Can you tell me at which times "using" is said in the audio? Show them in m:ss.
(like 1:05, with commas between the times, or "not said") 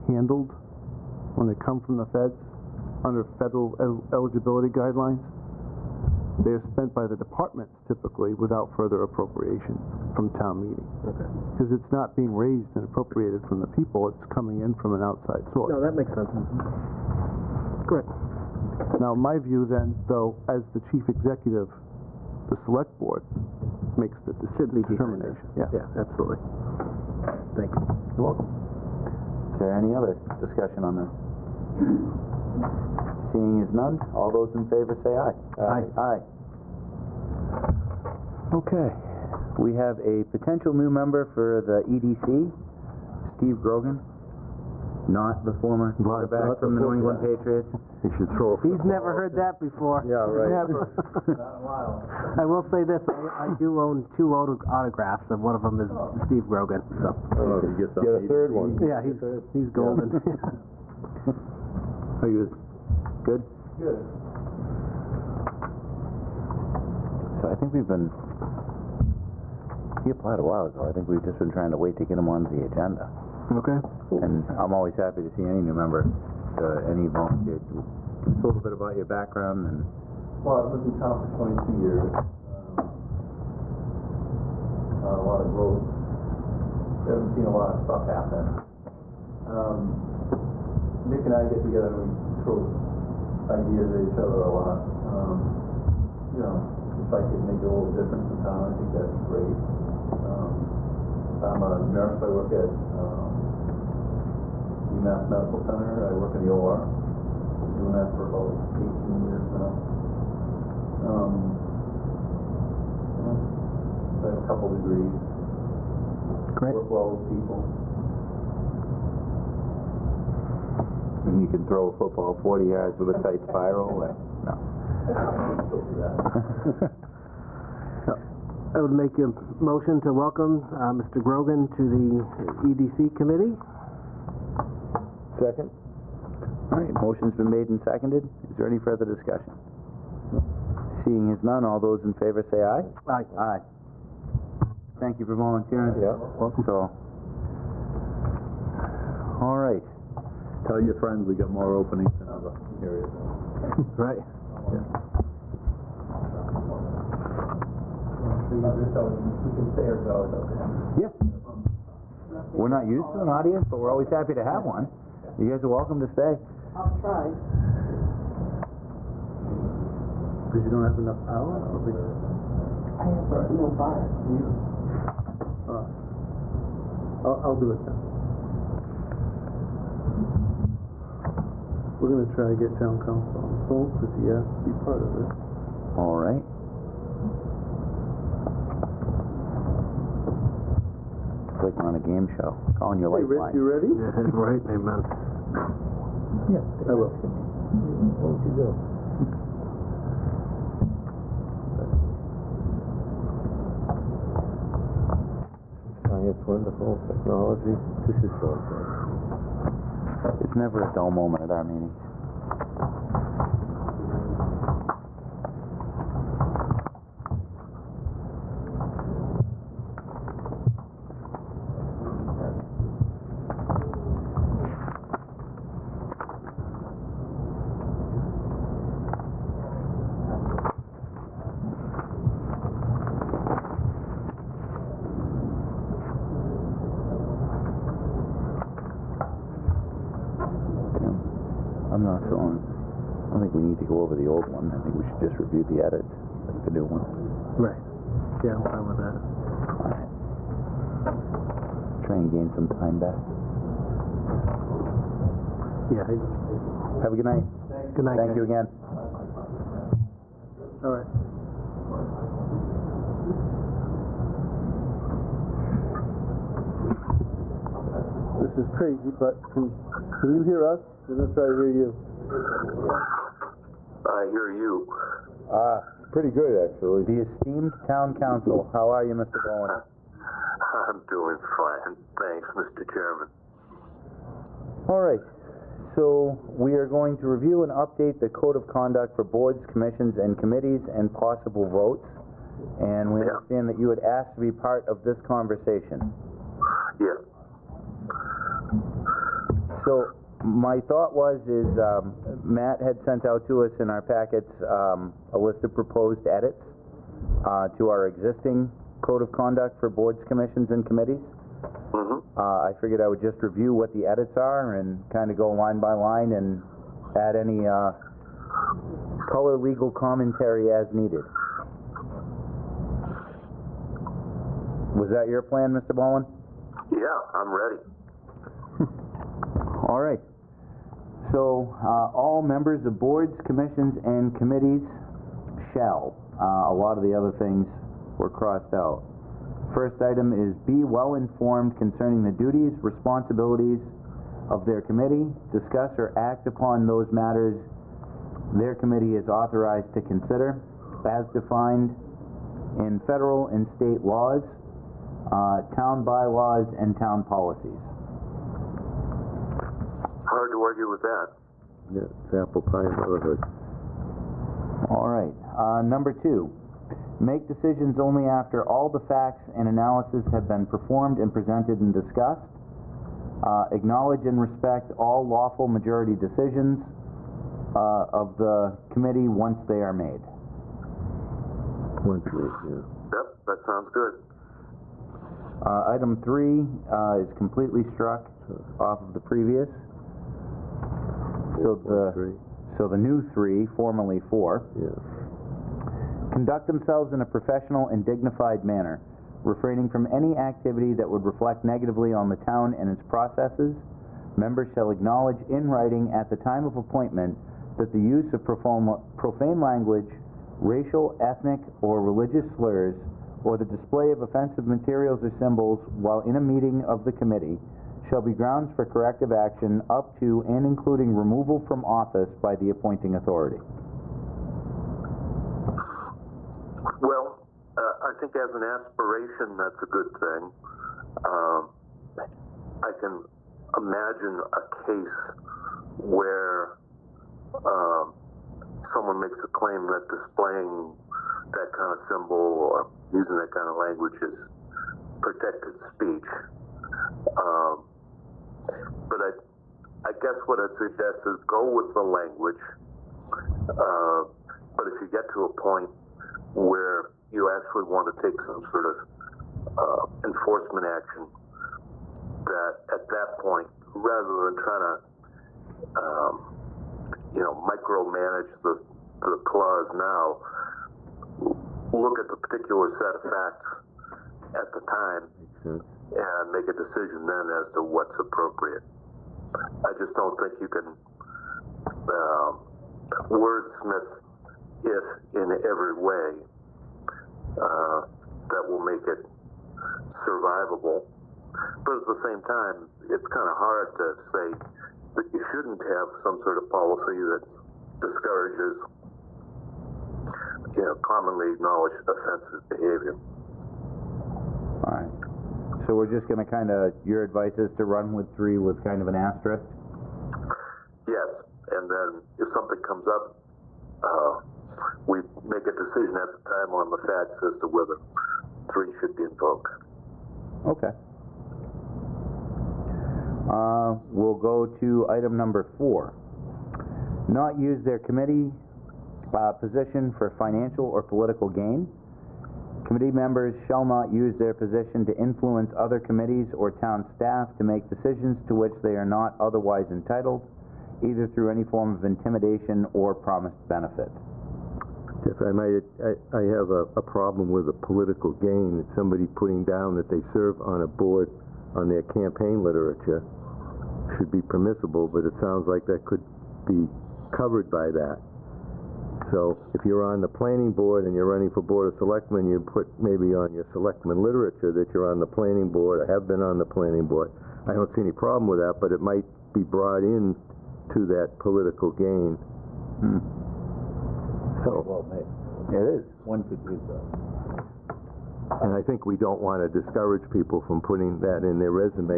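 7:23.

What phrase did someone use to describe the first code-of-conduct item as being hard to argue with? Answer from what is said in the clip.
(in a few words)
apple pie and motherhood.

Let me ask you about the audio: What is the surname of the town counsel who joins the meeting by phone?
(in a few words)
Bowen.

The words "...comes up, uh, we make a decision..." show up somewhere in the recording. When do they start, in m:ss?
8:32.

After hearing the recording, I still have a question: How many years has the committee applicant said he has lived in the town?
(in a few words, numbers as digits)
22 years.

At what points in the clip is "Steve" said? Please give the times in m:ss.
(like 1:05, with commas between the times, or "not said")
0:43, 0:56.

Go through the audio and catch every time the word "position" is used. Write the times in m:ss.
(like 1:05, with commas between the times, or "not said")
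8:49, 8:54.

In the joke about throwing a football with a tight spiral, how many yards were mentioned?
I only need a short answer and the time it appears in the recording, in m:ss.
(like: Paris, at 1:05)
40 yards, at 2:02.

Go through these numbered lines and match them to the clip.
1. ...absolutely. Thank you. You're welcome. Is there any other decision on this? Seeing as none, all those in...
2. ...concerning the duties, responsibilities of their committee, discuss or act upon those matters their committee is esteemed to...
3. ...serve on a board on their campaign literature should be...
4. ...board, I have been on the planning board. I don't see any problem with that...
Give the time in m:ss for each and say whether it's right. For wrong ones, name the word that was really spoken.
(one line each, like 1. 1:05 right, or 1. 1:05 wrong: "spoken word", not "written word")
1. 0:25 wrong: "discussion", not "decision"
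2. 5:41 wrong: "authorized", not "esteemed"
3. 9:10 right
4. 9:25 right.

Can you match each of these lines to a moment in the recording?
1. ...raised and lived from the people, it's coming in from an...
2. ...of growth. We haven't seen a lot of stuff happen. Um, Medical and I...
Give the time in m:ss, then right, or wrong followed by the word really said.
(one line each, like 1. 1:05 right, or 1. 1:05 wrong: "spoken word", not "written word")
1. 0:12 wrong: "appropriated", not "lived"
2. 1:25 wrong: "Nick", not "Medical".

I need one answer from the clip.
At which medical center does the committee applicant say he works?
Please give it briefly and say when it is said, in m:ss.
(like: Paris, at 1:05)
UMass Medical Center, at 1:44.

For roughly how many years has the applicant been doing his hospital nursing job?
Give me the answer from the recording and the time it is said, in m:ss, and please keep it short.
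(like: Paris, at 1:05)
18 years, at 1:48.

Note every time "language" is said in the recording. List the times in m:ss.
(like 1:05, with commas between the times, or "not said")
6:49, 7:23, 7:32.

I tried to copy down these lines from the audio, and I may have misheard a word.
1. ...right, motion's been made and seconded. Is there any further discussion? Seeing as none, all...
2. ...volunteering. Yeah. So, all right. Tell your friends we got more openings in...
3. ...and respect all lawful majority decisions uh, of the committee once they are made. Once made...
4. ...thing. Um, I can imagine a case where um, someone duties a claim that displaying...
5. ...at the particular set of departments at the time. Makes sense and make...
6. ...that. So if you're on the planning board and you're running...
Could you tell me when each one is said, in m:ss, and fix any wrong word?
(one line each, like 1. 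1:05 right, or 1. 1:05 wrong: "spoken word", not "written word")
1. 2:16 right
2. 2:25 right
3. 6:14 right
4. 7:10 wrong: "makes", not "duties"
5. 7:52 wrong: "facts", not "departments"
6. 9:17 right.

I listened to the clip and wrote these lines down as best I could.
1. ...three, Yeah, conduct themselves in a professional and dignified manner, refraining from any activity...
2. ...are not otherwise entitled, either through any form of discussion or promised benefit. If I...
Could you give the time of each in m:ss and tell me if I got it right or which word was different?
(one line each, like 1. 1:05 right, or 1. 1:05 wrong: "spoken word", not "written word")
1. 6:34 wrong: "four", not "three"
2. 8:58 wrong: "intimidation", not "discussion".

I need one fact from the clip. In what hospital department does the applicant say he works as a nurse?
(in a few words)
the OR.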